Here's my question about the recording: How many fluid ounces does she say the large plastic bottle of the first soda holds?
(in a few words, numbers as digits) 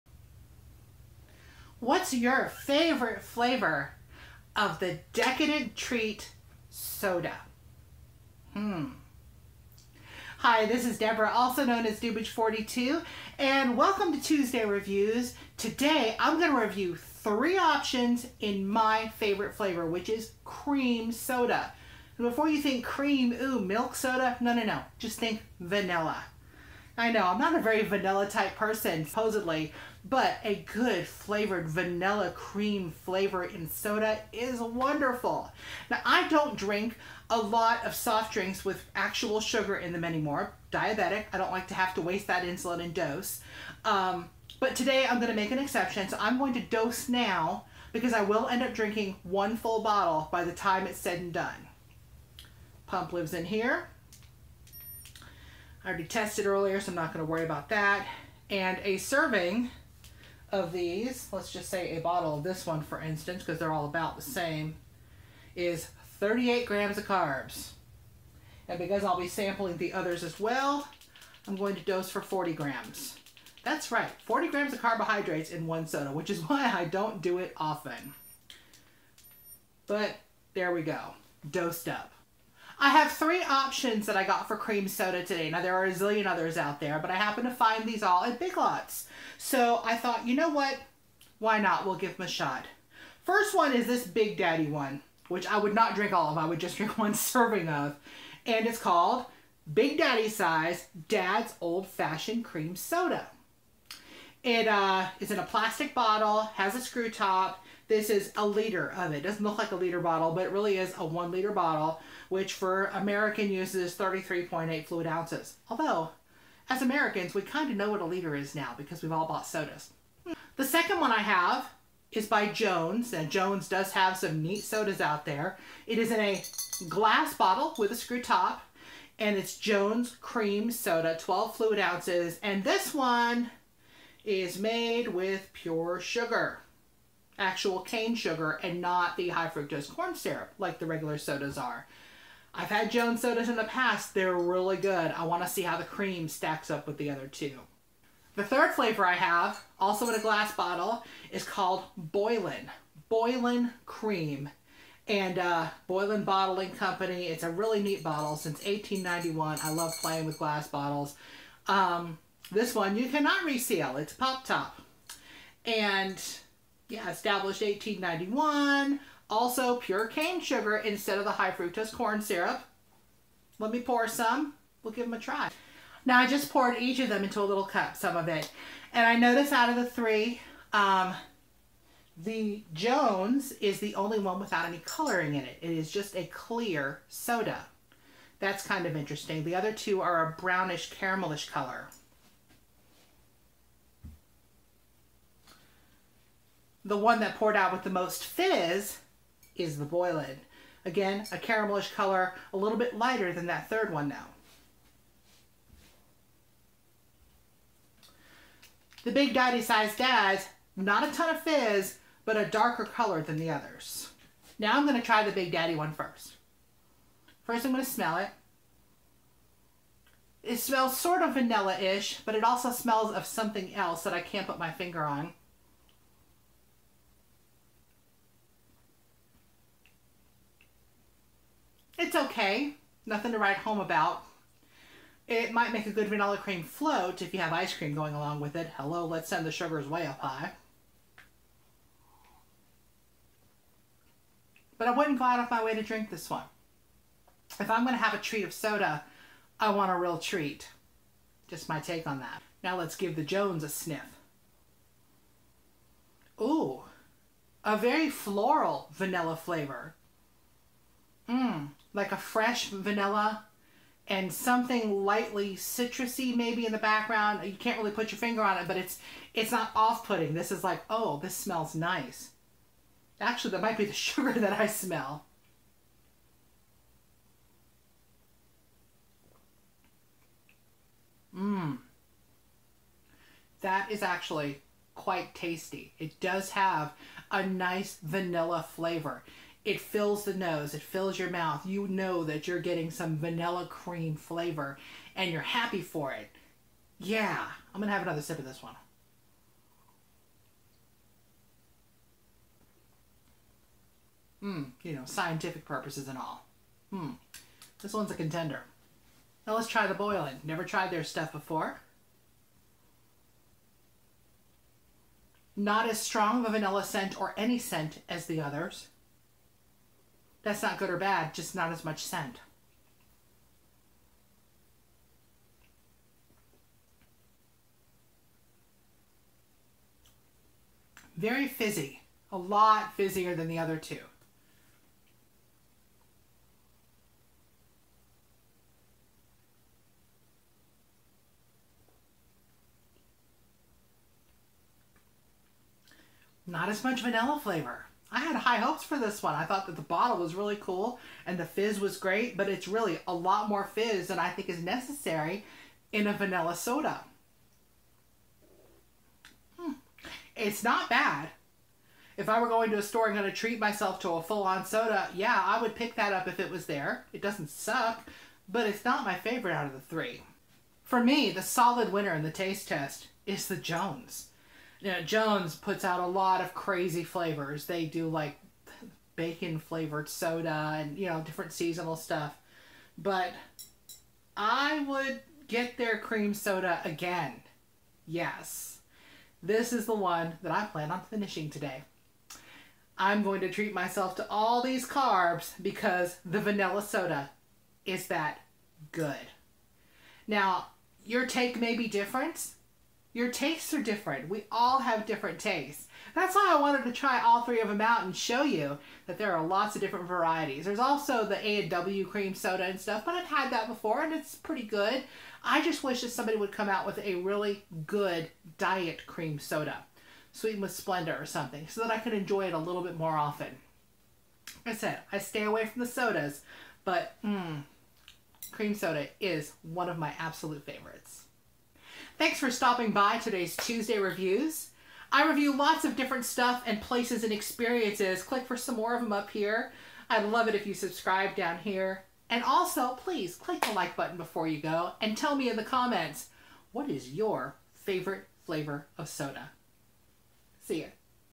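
33.8 fluid ounces.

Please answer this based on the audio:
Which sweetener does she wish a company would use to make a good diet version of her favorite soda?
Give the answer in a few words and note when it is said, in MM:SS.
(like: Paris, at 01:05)
Splenda, at 07:00.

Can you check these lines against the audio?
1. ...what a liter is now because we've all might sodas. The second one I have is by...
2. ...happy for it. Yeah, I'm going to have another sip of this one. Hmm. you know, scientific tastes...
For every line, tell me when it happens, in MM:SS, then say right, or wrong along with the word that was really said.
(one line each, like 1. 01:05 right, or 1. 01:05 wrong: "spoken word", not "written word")
1. 01:57 wrong: "bought", not "might"
2. 04:55 wrong: "purposes", not "tastes".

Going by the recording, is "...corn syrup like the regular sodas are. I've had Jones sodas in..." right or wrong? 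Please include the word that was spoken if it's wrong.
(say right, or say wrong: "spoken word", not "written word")
right.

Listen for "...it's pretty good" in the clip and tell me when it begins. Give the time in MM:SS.
06:54.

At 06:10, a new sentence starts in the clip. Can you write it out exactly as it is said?
For me, the solid winner in the taste test is the Jones you know, Jones puts out a lot of crazy flavors.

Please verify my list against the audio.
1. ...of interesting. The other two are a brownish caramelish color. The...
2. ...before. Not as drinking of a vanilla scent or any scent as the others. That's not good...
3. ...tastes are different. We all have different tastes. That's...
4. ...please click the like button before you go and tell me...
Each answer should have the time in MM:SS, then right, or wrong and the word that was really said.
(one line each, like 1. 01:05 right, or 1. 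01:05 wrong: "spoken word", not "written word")
1. 03:08 right
2. 05:11 wrong: "strong", not "drinking"
3. 06:43 right
4. 07:22 right.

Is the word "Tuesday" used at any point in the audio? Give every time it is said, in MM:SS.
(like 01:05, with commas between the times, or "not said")
00:14, 07:13.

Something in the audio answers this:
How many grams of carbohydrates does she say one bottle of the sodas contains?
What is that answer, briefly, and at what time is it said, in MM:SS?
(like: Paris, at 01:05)
38 grams, at 01:06.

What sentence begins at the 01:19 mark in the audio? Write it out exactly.
But there we go, dosed up.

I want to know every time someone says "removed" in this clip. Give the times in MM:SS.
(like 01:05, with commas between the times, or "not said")
not said.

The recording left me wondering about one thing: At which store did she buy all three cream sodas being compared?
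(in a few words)
Big Lots.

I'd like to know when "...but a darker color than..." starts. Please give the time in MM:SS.
03:32.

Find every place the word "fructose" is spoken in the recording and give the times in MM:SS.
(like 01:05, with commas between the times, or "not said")
02:19, 02:51.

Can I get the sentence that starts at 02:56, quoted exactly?
Now, I just poured each of them into a little cup, some of it.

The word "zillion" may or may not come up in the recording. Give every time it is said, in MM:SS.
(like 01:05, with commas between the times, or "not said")
01:25.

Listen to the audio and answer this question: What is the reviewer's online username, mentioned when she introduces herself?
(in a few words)
Dubbage42.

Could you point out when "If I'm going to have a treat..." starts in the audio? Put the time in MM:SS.
04:07.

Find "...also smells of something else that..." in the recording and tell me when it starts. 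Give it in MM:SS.
03:42.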